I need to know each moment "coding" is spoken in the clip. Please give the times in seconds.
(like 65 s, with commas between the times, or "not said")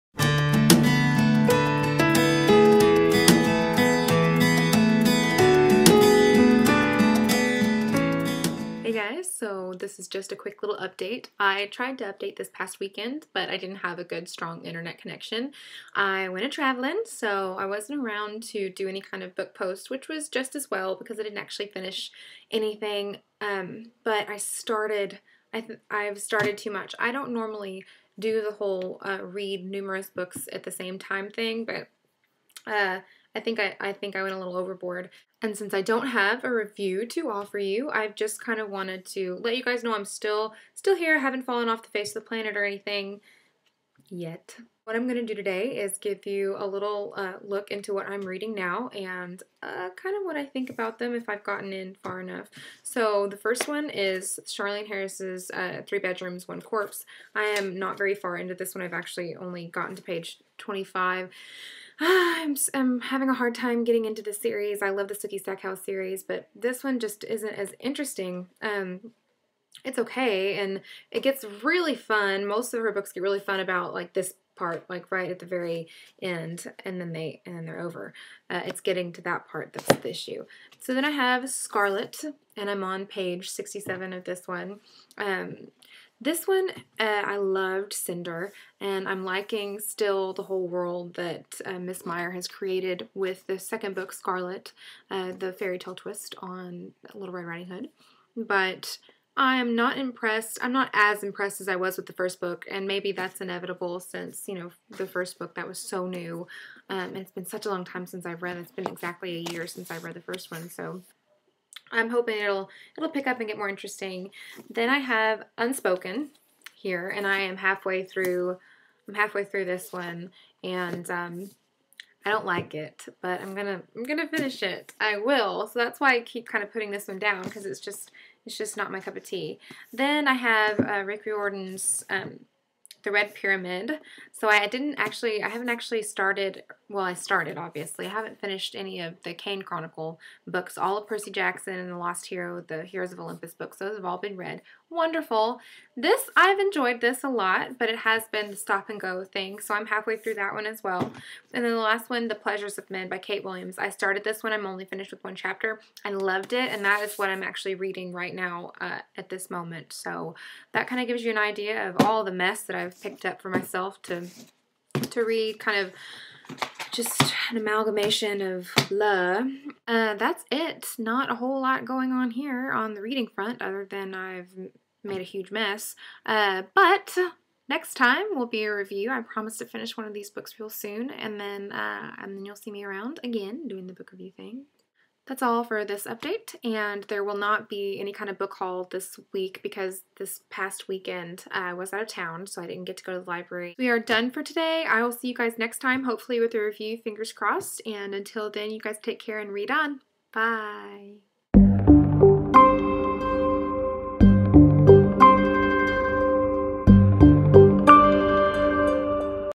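not said.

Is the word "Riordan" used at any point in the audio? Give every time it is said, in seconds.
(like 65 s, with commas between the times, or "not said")
131 s.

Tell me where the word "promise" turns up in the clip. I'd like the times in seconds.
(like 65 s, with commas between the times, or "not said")
179 s.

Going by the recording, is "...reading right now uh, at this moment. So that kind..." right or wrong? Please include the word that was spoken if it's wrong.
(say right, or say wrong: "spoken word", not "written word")
right.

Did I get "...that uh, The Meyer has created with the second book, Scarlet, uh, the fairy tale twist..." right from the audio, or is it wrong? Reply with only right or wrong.
wrong.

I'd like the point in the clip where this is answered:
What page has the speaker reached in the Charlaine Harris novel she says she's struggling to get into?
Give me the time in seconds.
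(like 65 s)
60 s.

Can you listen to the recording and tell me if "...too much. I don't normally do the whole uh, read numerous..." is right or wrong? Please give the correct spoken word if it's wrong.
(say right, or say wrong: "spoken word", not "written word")
right.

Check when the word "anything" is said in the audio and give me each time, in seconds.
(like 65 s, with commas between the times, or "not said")
22 s, 42 s.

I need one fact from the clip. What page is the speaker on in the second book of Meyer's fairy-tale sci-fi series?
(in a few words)
67.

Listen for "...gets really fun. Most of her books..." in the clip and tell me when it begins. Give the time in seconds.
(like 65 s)
71 s.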